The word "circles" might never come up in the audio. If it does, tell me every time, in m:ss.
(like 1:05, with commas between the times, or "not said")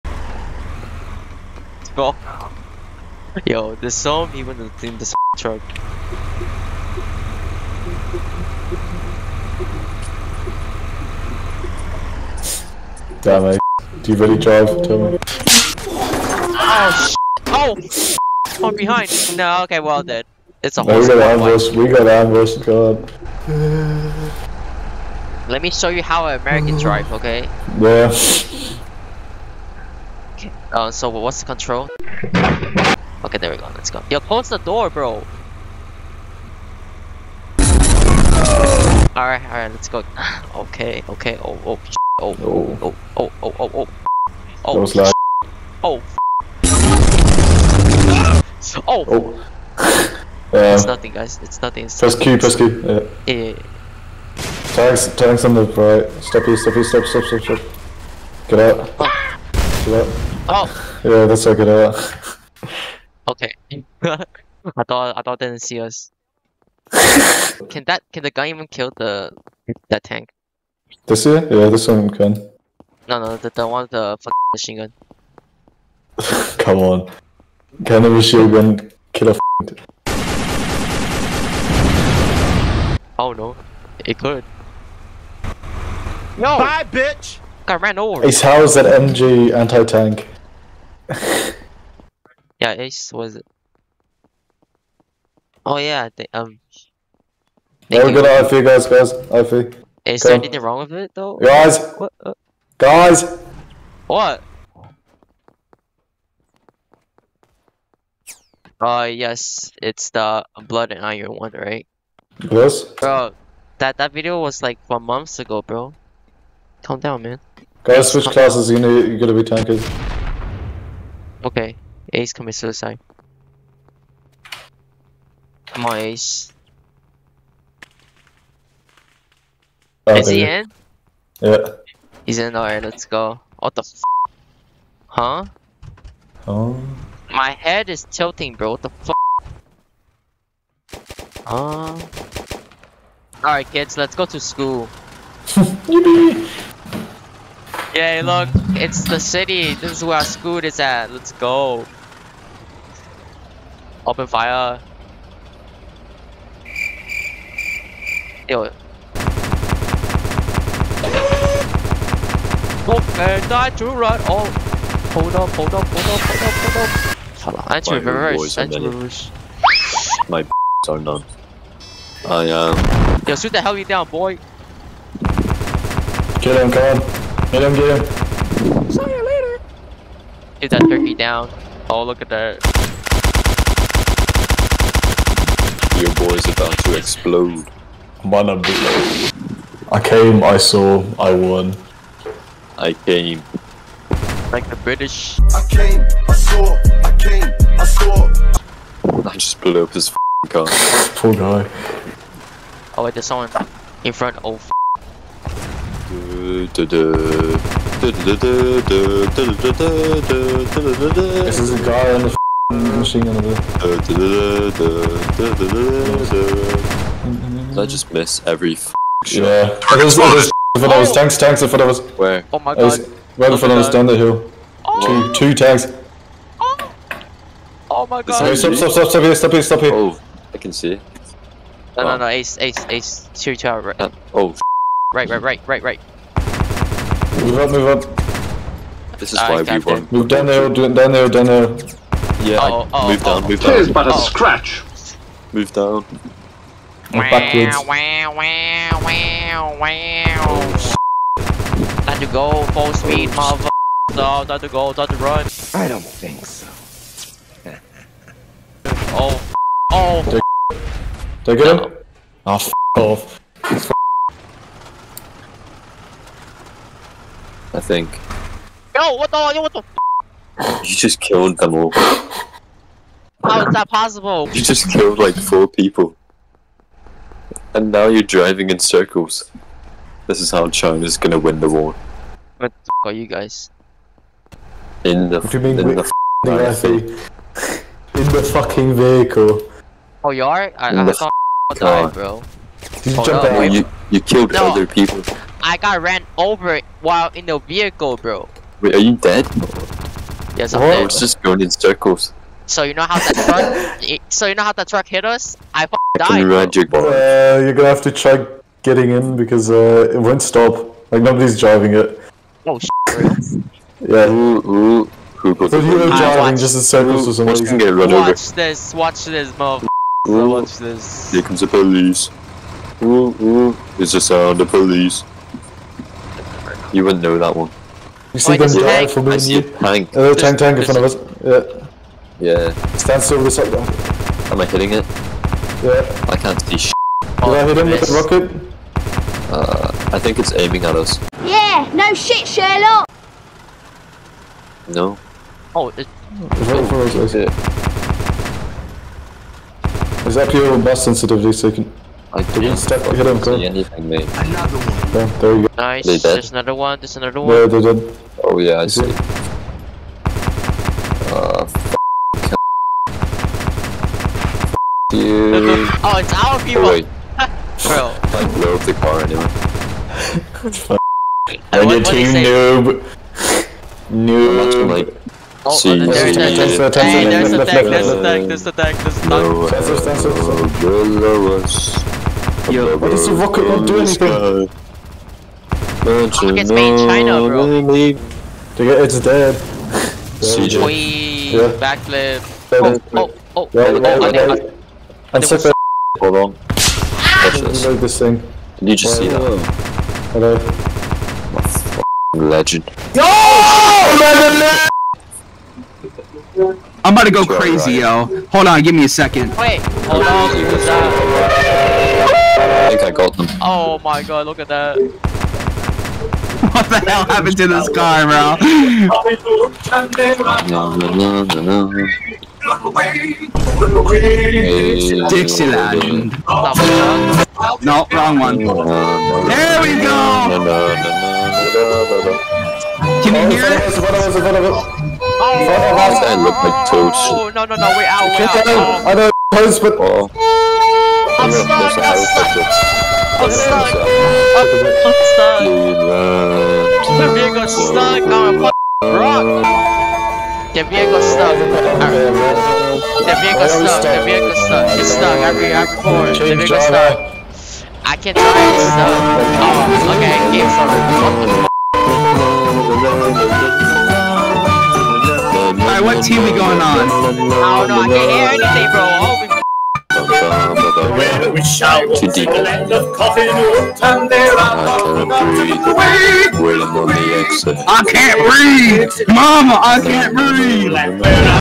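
4:38, 5:01, 5:16.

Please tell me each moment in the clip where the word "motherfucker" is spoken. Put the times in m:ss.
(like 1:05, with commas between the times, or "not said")
4:13, 5:19.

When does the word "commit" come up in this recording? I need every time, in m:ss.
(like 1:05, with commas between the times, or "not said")
2:02.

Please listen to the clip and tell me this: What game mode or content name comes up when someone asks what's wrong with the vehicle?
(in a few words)
Blood and Iron.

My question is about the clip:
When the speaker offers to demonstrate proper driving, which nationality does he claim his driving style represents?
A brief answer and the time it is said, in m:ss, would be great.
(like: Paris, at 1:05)
American, at 0:26.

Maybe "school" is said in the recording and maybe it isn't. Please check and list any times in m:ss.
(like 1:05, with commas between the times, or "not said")
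2:24, 2:30.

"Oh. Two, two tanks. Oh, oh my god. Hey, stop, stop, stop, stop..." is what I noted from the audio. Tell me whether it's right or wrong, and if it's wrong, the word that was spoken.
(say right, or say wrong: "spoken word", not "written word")
right.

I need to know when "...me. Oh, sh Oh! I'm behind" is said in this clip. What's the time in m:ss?
0:15.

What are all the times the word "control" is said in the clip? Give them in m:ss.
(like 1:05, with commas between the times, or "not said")
0:31.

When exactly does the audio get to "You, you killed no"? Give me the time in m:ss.
4:53.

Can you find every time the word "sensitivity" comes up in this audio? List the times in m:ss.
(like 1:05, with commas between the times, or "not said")
5:51.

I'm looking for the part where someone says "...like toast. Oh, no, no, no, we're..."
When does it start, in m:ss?
7:16.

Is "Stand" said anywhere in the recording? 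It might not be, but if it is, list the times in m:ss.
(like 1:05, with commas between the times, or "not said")
5:32.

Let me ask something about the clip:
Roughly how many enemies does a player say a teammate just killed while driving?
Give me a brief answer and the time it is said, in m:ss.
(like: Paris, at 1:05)
4, at 4:35.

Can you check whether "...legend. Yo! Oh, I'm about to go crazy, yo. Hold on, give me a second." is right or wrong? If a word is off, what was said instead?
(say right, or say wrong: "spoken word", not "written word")
right.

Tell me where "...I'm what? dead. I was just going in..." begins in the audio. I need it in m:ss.
5:00.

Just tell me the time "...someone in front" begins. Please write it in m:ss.
3:23.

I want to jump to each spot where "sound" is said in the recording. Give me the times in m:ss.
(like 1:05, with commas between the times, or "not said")
5:24.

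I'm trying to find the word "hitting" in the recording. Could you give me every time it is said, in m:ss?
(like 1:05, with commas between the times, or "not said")
5:34.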